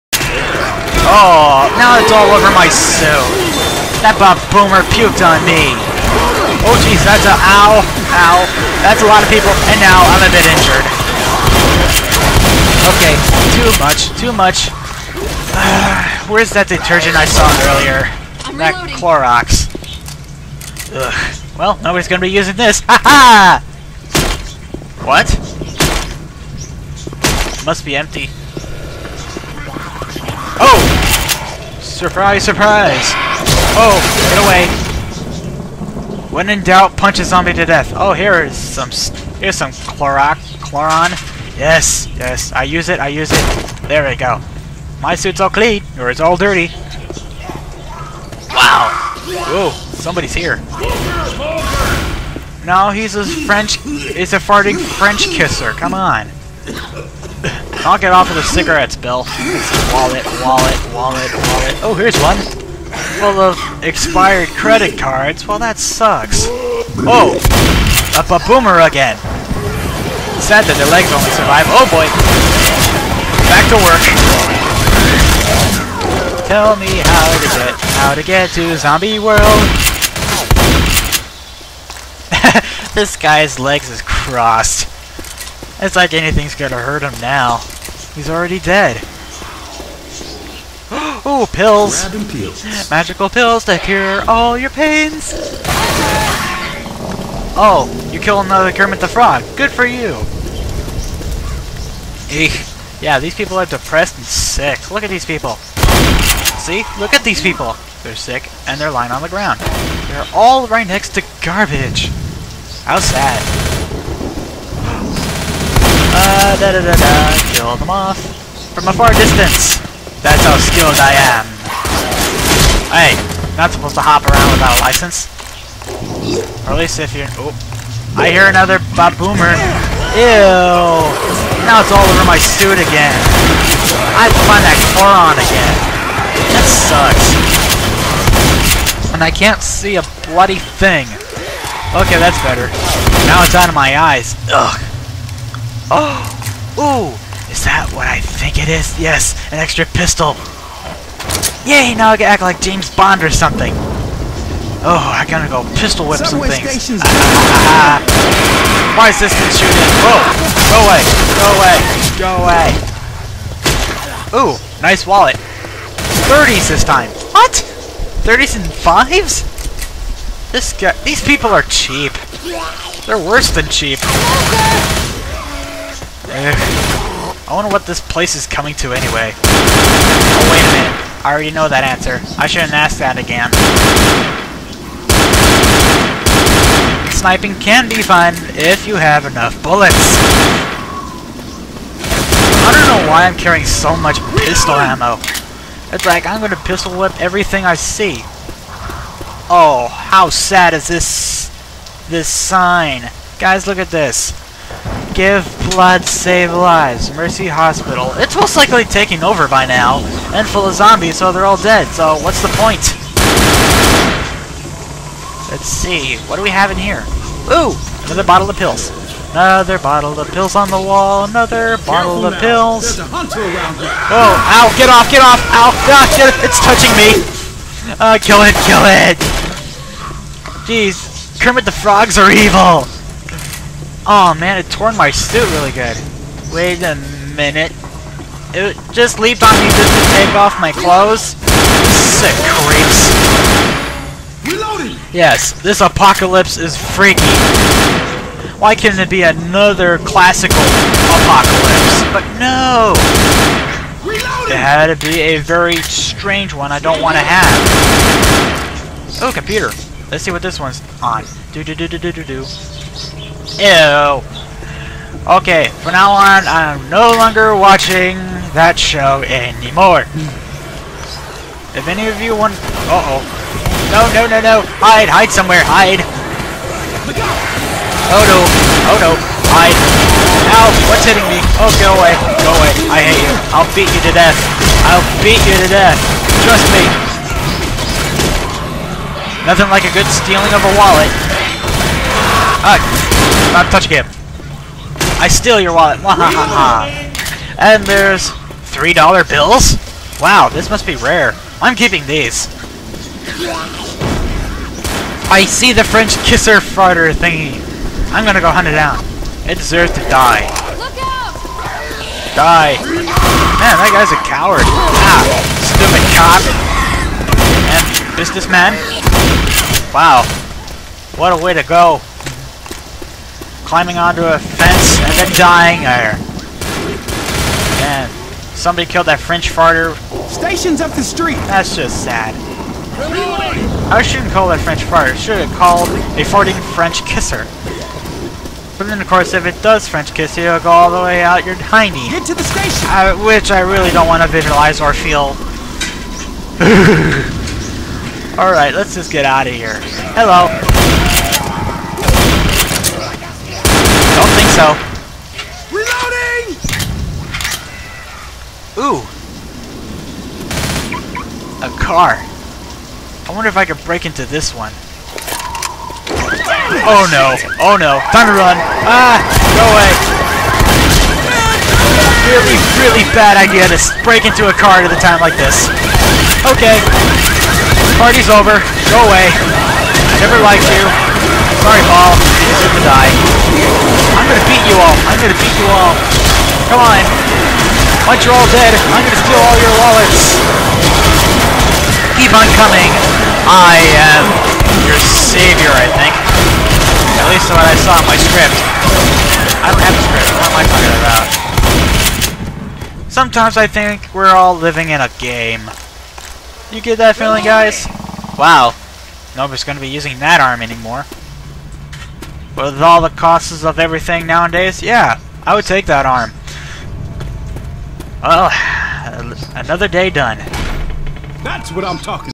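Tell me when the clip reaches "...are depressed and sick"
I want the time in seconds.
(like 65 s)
103 s.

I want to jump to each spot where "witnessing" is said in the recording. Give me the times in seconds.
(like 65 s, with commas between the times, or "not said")
not said.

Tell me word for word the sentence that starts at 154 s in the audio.
Oh, I gotta go pistol whip some things.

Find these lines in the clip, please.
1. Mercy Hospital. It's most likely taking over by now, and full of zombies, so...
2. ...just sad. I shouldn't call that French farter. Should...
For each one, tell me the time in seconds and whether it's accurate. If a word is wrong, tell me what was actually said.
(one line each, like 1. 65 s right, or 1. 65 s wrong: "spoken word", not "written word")
1. 207 s right
2. 331 s right.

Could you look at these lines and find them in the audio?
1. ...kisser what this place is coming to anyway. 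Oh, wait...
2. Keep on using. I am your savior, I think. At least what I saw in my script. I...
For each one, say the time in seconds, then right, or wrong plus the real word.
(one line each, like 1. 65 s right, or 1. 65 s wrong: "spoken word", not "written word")
1. 177 s wrong: "wonder", not "kisser"
2. 392 s wrong: "coming", not "using".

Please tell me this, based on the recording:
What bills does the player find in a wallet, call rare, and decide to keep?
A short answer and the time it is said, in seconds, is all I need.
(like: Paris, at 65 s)
3 dollar bills, at 298 s.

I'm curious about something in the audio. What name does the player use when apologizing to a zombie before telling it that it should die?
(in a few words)
Paul.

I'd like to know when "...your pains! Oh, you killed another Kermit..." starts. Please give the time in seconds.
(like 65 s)
94 s.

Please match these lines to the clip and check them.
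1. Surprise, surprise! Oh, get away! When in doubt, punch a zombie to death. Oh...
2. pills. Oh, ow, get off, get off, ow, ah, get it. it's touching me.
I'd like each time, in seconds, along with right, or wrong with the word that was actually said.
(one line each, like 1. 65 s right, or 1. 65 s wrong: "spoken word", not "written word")
1. 32 s right
2. 222 s right.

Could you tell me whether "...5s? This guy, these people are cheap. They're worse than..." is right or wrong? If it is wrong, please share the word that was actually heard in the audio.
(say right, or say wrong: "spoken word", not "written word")
right.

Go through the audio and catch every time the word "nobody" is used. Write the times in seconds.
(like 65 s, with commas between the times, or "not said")
21 s, 409 s.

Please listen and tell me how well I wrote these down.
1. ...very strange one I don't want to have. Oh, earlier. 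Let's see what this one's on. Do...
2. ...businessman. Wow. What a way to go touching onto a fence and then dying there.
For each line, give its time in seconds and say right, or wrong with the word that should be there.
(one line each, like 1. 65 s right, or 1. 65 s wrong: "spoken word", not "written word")
1. 255 s wrong: "computer", not "earlier"
2. 318 s wrong: "climbing", not "touching".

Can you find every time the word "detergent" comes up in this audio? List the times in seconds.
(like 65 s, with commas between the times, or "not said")
16 s.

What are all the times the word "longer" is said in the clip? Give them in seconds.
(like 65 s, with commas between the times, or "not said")
267 s.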